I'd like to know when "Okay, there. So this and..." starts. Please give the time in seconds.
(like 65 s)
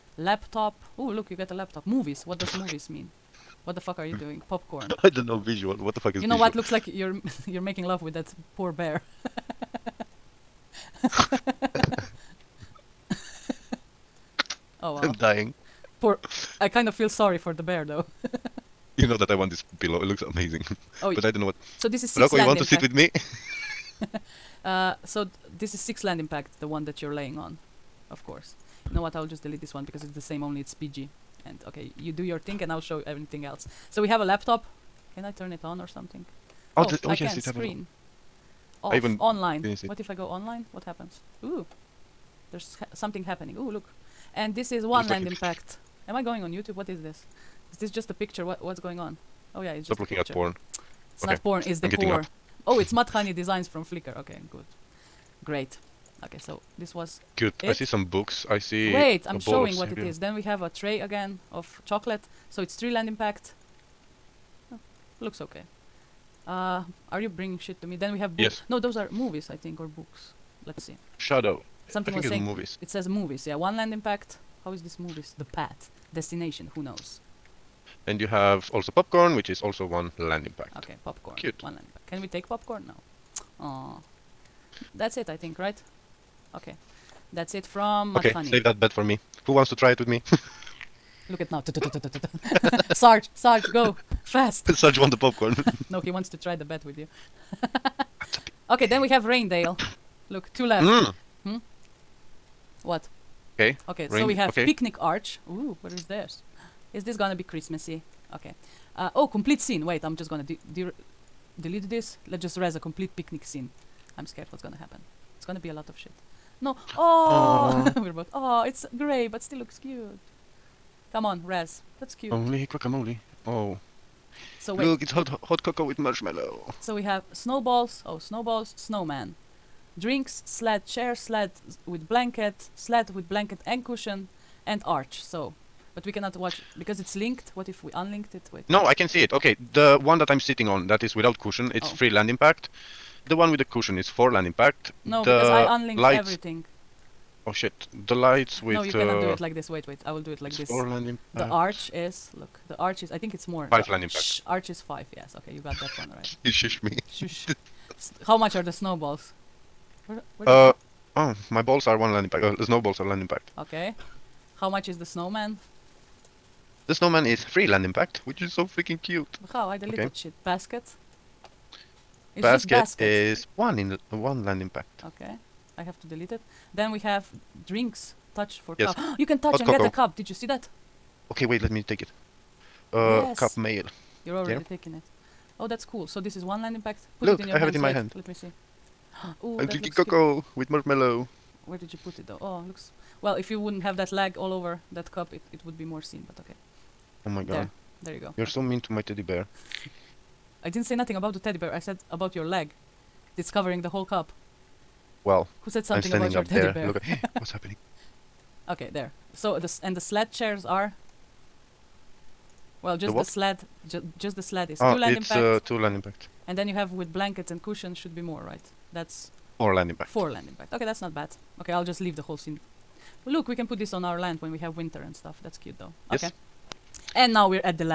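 208 s.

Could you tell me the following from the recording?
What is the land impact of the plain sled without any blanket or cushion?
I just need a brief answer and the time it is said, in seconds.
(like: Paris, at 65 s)
2, at 215 s.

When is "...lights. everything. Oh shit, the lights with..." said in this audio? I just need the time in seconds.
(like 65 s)
145 s.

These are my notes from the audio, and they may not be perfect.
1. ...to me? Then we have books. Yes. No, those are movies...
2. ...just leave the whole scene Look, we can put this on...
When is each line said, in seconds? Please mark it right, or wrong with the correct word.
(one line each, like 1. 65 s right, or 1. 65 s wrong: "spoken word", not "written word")
1. 67 s right
2. 221 s right.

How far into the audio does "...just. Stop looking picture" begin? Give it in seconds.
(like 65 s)
49 s.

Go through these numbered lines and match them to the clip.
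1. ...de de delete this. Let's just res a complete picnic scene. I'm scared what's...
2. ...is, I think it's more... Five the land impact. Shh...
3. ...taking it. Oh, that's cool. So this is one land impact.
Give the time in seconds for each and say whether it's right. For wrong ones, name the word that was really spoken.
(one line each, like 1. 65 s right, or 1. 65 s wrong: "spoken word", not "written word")
1. 110 s right
2. 153 s right
3. 184 s right.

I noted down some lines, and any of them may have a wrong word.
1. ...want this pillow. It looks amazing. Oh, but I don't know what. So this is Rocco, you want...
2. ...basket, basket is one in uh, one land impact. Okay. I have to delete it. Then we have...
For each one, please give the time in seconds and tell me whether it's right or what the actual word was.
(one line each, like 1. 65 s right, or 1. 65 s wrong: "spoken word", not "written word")
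1. 19 s right
2. 172 s right.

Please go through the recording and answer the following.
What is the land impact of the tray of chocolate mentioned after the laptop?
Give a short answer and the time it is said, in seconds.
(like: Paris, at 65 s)
3, at 62 s.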